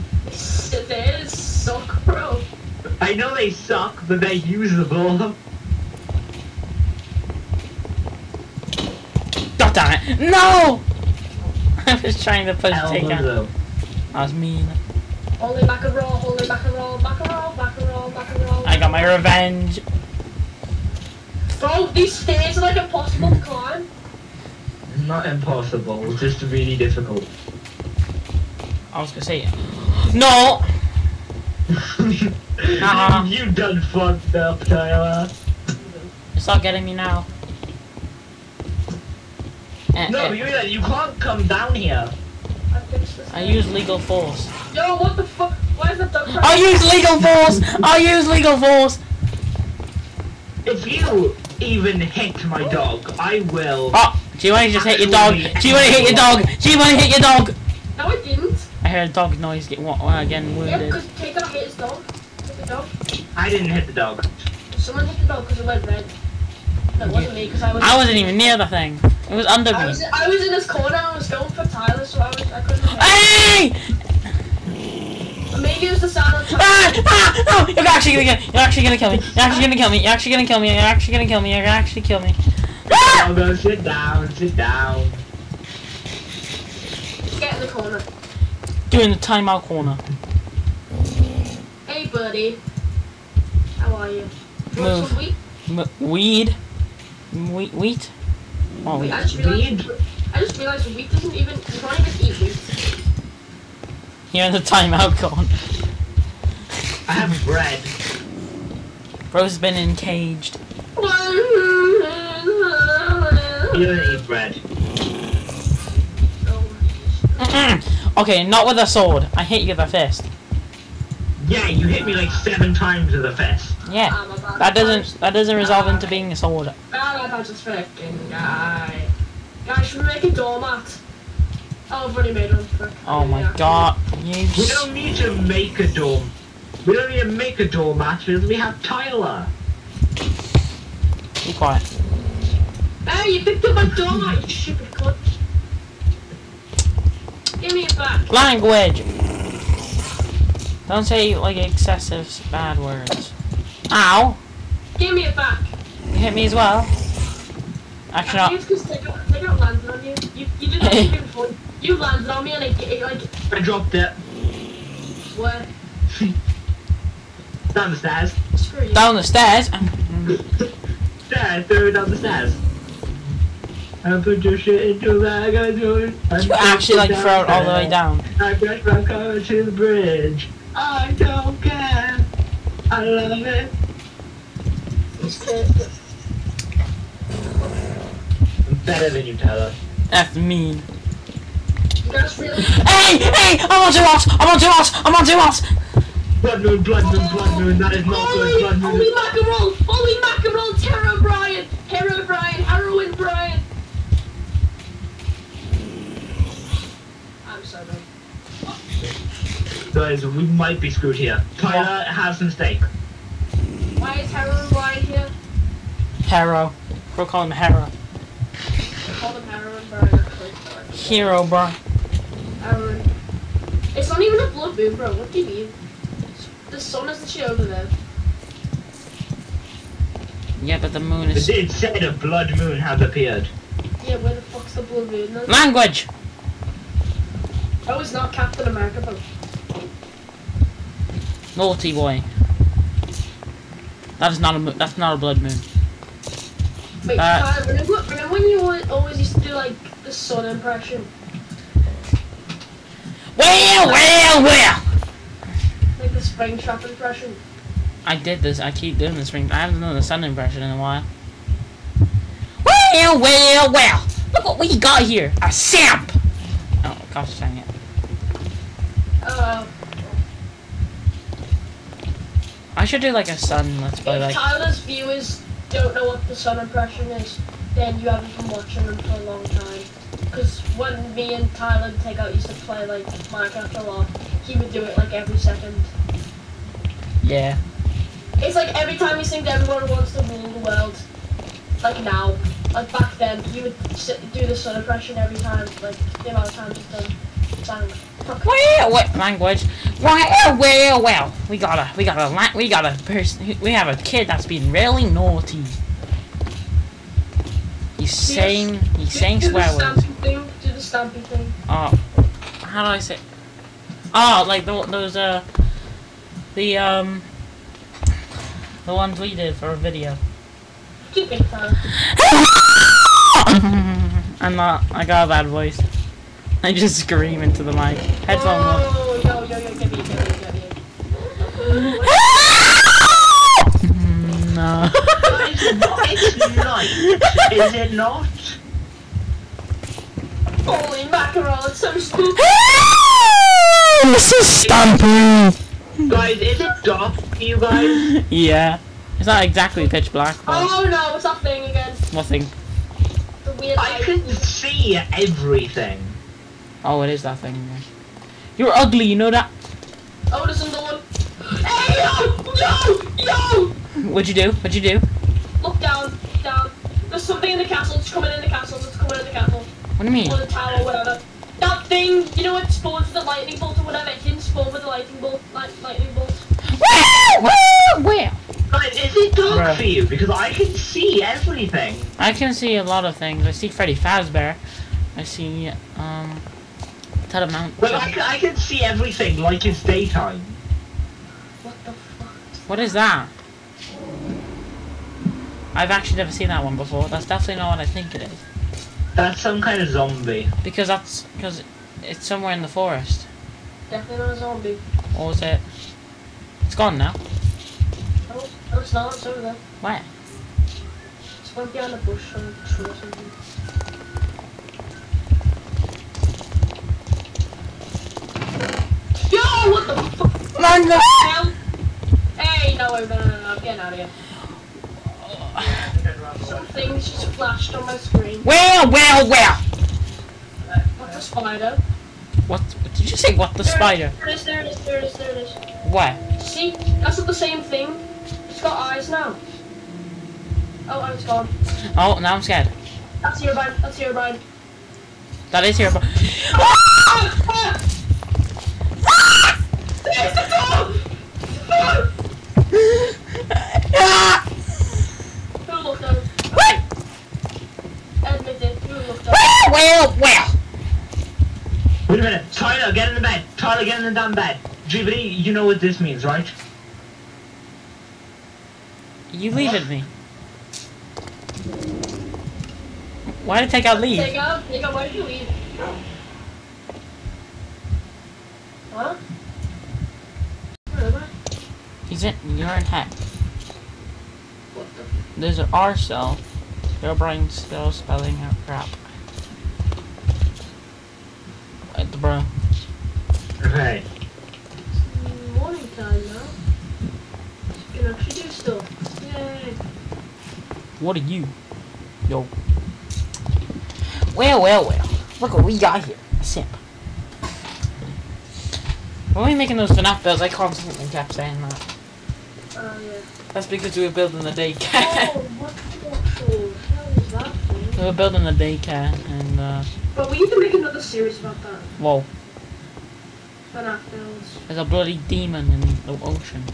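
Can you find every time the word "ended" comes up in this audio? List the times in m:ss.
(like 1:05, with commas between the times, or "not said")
not said.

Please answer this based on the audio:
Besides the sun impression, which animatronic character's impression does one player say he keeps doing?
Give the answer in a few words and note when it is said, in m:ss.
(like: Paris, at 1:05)
Springtrap, at 4:16.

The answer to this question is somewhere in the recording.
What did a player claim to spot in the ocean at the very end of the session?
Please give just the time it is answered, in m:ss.
8:44.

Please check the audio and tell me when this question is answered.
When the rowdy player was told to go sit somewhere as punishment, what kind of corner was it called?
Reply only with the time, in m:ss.
1:29.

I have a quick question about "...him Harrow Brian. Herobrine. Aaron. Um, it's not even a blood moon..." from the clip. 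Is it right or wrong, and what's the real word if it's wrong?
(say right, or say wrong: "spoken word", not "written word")
right.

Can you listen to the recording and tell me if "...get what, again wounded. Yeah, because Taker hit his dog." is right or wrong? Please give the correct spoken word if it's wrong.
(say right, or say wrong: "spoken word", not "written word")
right.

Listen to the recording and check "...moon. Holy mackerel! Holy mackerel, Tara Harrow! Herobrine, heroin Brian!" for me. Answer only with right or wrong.
wrong.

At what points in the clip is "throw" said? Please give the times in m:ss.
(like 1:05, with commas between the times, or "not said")
2:51, 2:57.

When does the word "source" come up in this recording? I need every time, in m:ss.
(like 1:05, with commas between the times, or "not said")
not said.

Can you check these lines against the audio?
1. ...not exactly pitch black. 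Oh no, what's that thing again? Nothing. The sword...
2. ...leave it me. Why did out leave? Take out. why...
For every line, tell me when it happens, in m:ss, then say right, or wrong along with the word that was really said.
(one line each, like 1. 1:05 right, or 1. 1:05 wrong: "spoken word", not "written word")
1. 5:49 wrong: "weird", not "sword"
2. 7:49 right.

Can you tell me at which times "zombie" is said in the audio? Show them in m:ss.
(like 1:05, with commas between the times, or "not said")
6:39, 6:44.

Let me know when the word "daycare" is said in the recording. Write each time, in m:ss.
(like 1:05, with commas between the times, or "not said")
8:34, 8:38.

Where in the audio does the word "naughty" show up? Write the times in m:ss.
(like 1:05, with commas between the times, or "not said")
4:01, 5:05.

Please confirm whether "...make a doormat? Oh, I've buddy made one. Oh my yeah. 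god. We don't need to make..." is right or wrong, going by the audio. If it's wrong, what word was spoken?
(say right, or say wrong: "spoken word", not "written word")
wrong: "already", not "buddy".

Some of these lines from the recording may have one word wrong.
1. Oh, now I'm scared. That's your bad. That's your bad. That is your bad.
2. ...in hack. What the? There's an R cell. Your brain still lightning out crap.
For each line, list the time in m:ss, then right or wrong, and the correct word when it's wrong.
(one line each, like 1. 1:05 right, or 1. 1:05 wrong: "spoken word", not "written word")
1. 7:21 right
2. 8:02 wrong: "spelling", not "lightning".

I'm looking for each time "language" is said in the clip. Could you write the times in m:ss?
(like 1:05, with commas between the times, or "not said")
2:28, 3:55, 4:59.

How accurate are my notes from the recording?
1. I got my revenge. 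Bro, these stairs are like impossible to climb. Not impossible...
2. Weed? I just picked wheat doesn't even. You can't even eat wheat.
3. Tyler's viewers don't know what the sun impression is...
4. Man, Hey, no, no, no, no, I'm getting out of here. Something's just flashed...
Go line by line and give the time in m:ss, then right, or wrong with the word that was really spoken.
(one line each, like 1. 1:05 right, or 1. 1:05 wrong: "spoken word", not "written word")
1. 0:18 right
2. 1:39 wrong: "realized", not "picked"
3. 4:34 right
4. 7:00 right.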